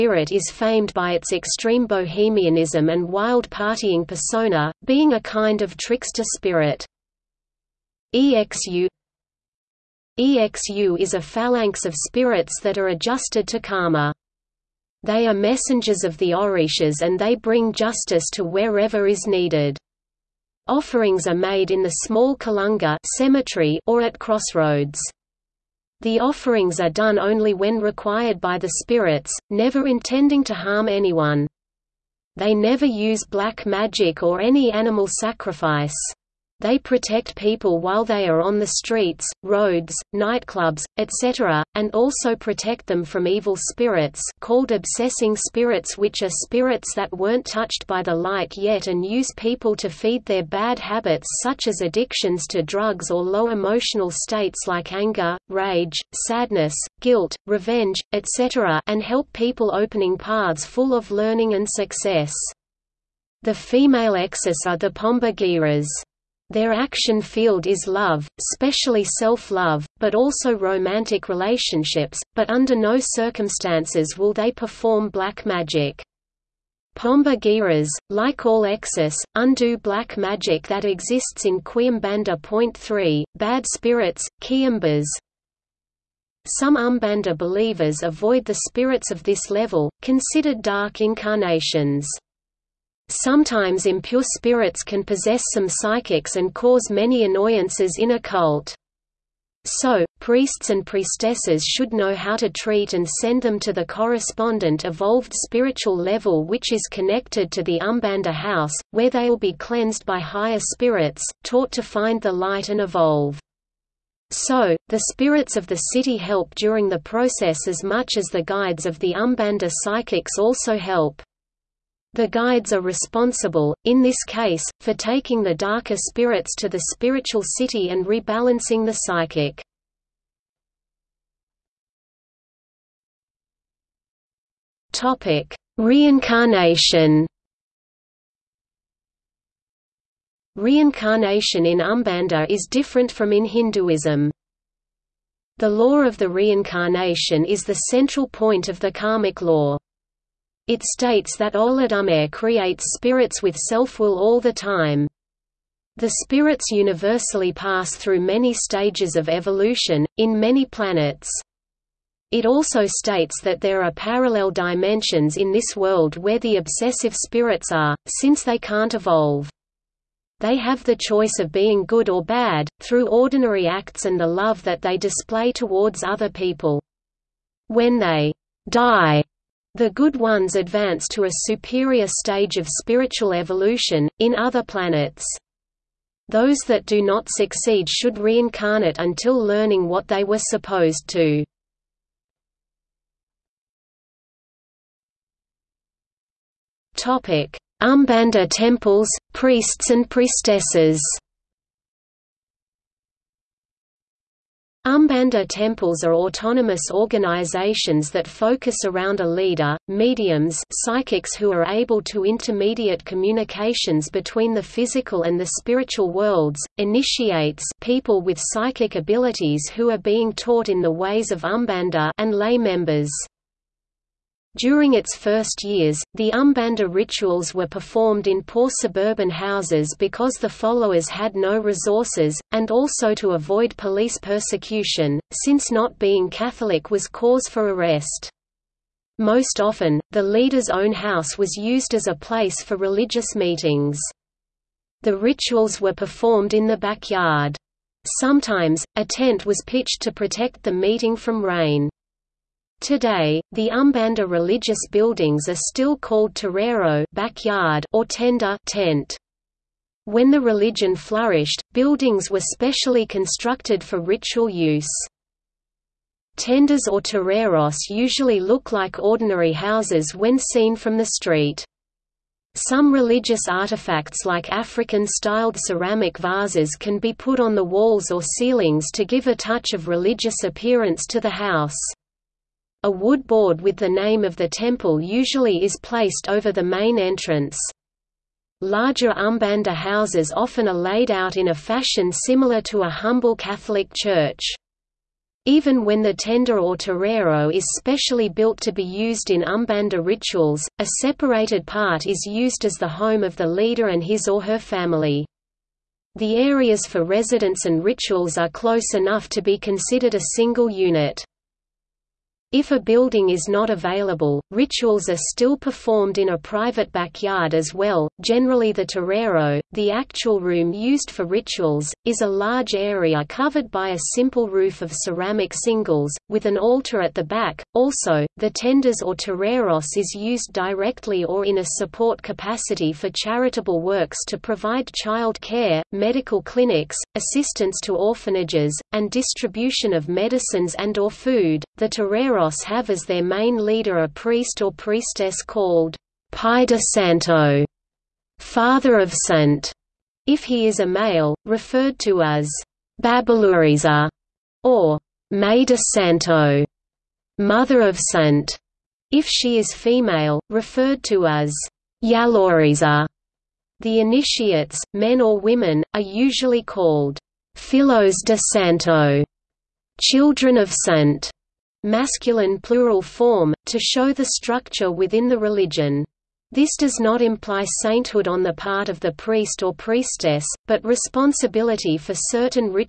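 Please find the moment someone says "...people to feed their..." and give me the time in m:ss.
0:49.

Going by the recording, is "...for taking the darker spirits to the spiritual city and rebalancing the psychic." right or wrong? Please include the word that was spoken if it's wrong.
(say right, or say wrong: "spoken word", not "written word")
right.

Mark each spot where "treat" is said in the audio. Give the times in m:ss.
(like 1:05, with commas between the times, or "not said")
1:42.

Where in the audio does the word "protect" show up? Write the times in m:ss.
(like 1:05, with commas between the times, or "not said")
0:36, 0:42, 4:10.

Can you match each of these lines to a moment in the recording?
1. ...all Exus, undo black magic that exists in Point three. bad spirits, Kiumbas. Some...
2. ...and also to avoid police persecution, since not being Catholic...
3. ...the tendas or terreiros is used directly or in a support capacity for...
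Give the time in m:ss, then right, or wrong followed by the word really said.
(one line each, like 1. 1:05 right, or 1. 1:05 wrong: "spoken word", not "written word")
1. 1:18 right
2. 3:52 right
3. 5:28 right.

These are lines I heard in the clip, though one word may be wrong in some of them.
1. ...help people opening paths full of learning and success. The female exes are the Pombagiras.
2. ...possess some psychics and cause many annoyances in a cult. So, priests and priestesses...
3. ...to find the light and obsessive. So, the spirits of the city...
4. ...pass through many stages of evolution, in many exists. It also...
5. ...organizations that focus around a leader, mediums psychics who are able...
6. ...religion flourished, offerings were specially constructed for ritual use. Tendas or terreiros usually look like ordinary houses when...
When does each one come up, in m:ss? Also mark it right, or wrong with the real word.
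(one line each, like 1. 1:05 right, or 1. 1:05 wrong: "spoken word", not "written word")
1. 0:59 right
2. 1:35 right
3. 1:51 wrong: "evolve", not "obsessive"
4. 2:37 wrong: "planets", not "exists"
5. 3:26 right
6. 4:20 wrong: "buildings", not "offerings".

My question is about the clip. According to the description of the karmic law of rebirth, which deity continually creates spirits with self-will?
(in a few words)
Olodumare.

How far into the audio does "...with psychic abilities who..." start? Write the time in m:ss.
3:38.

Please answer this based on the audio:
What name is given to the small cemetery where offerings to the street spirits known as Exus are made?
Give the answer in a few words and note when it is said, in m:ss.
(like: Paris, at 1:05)
Kalunga, at 0:22.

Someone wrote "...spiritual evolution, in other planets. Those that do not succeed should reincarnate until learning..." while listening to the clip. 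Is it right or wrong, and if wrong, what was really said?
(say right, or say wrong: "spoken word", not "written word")
right.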